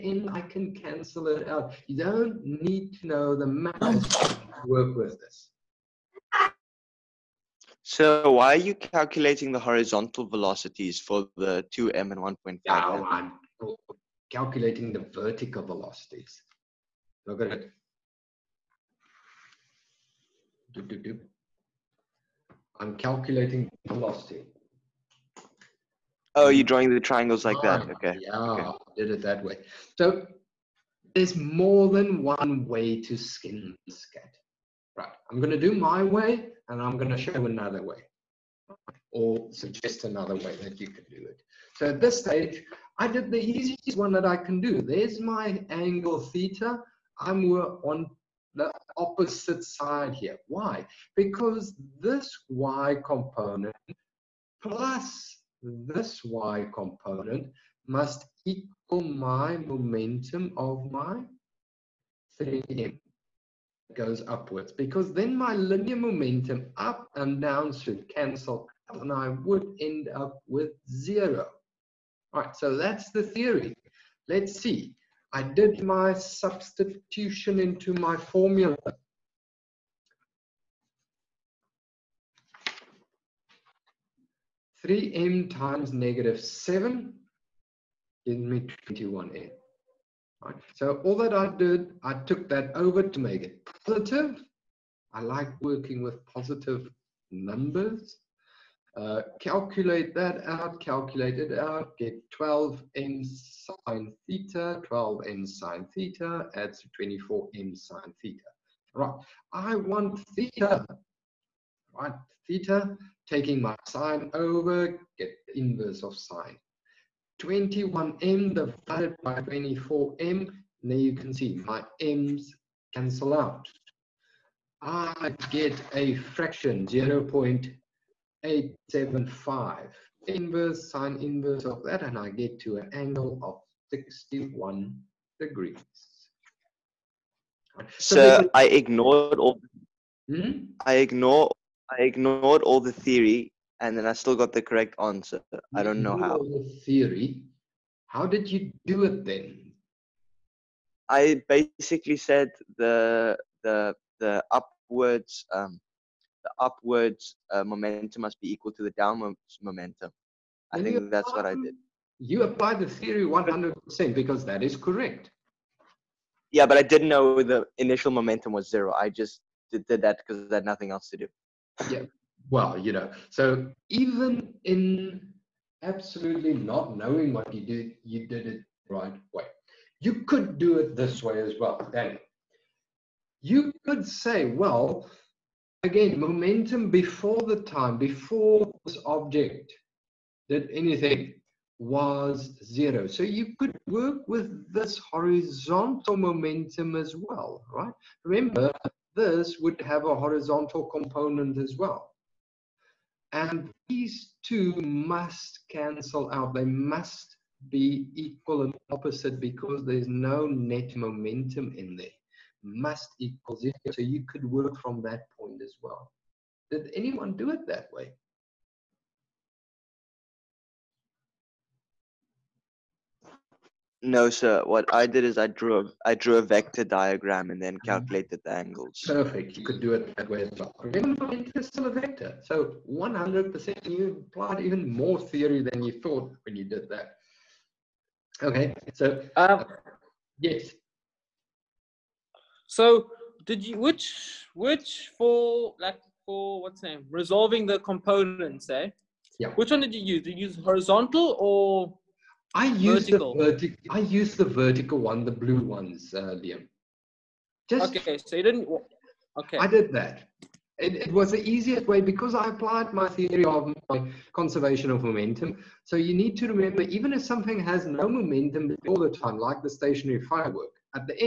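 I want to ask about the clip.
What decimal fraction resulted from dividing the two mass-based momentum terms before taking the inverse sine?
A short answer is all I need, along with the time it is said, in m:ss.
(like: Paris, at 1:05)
0.875, at 2:06.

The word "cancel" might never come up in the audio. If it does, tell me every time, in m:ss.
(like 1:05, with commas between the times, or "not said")
0:00, 1:08, 2:02, 3:25.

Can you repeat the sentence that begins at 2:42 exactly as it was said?
You applied the theory 100% because that is correct.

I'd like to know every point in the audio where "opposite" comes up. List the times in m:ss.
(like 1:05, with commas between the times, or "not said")
0:48, 3:28.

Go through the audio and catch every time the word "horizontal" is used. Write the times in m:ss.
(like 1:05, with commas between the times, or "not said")
0:09, 3:15, 3:20, 4:10.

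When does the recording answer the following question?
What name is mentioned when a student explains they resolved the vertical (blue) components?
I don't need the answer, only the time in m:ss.
4:16.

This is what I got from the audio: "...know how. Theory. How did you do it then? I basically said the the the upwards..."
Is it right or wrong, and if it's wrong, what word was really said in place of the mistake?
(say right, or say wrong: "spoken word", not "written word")
right.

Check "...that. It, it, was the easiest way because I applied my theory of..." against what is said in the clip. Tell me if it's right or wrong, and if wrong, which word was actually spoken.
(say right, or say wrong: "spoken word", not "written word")
right.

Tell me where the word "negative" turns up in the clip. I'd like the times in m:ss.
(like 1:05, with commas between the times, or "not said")
1:25.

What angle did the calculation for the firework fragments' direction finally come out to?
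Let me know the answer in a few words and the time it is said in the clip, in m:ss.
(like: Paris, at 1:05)
61 degrees, at 2:13.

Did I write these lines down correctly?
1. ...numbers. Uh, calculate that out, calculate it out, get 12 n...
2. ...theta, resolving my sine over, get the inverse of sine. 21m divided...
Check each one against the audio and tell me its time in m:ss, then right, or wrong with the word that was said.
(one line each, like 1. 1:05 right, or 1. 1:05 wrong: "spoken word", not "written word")
1. 1:37 right
2. 1:52 wrong: "taking", not "resolving".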